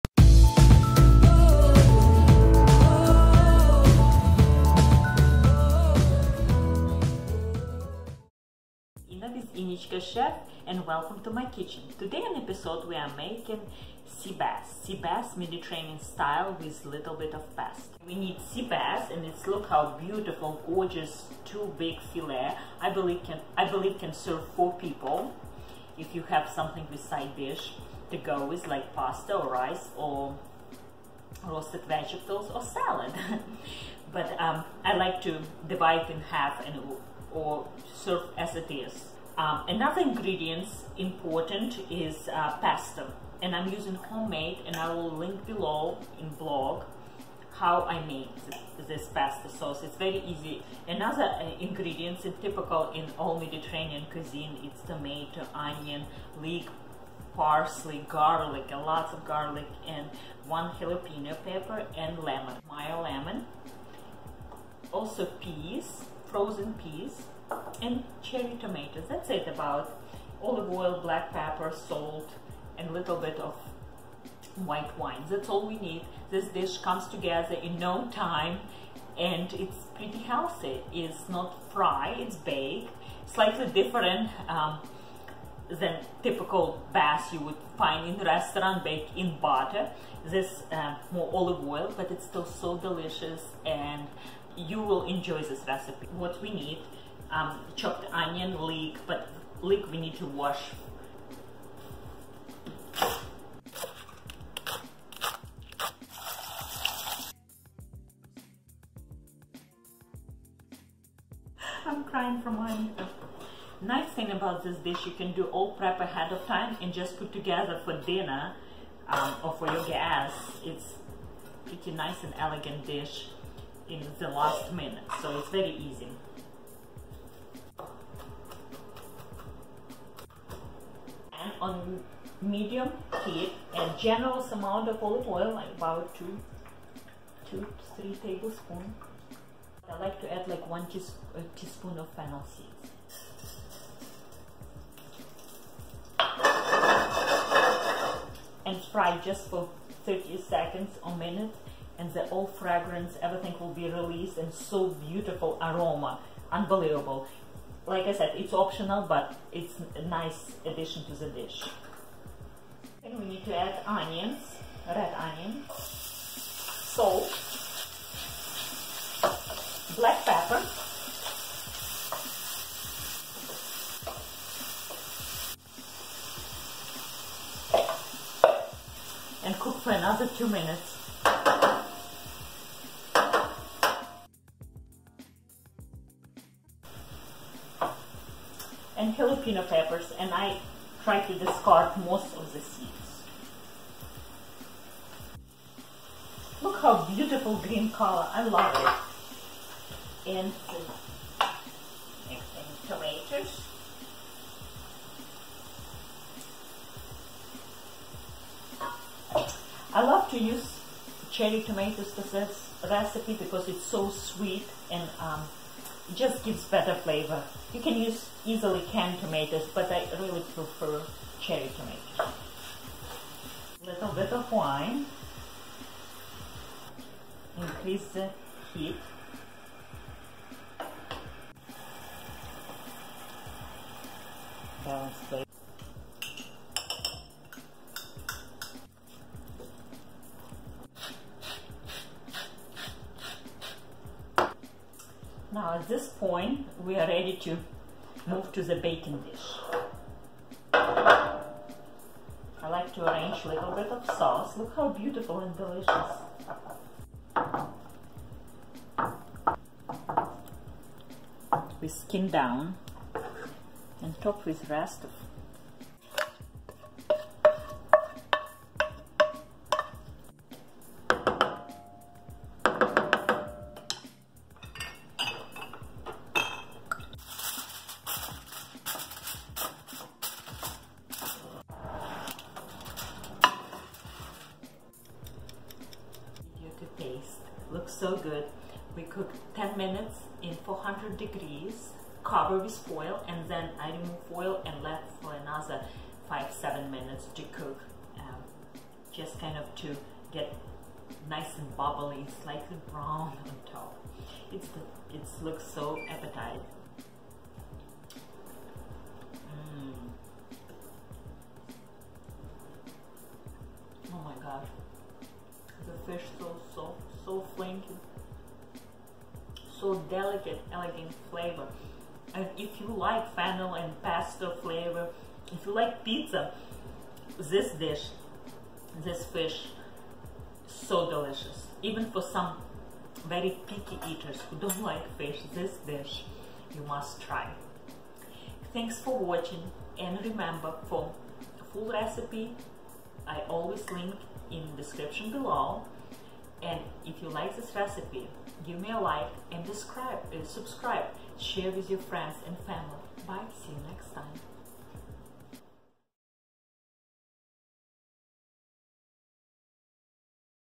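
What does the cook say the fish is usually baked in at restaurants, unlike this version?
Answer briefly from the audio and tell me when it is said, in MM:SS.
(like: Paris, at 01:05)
butter, at 01:29.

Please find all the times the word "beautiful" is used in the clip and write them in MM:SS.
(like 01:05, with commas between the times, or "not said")
00:19, 02:34, 03:17, 04:14.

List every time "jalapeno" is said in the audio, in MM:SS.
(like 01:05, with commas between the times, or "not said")
01:00, 03:09.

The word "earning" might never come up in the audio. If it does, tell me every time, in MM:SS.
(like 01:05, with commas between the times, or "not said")
not said.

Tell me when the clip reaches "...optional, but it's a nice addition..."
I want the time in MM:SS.
02:38.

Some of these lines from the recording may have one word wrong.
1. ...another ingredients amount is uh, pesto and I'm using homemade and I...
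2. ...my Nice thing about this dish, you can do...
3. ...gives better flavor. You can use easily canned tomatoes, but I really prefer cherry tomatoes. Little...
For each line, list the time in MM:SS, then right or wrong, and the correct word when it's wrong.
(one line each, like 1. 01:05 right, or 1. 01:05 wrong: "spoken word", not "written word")
1. 00:39 wrong: "important", not "amount"
2. 01:52 right
3. 03:36 right.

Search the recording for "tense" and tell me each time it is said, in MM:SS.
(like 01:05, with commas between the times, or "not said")
not said.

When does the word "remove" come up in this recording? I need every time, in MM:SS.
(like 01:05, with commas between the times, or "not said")
04:53.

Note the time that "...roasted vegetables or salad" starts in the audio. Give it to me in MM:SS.
00:31.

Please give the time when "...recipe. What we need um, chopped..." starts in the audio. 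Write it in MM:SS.
01:35.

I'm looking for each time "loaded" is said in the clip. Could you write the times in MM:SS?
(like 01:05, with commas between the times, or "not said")
not said.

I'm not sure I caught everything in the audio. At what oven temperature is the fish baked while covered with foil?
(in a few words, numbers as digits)
400 degrees.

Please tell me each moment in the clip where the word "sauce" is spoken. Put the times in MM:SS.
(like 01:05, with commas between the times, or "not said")
00:49, 04:14.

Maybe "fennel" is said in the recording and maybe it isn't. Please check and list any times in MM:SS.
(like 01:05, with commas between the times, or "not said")
02:22, 05:23.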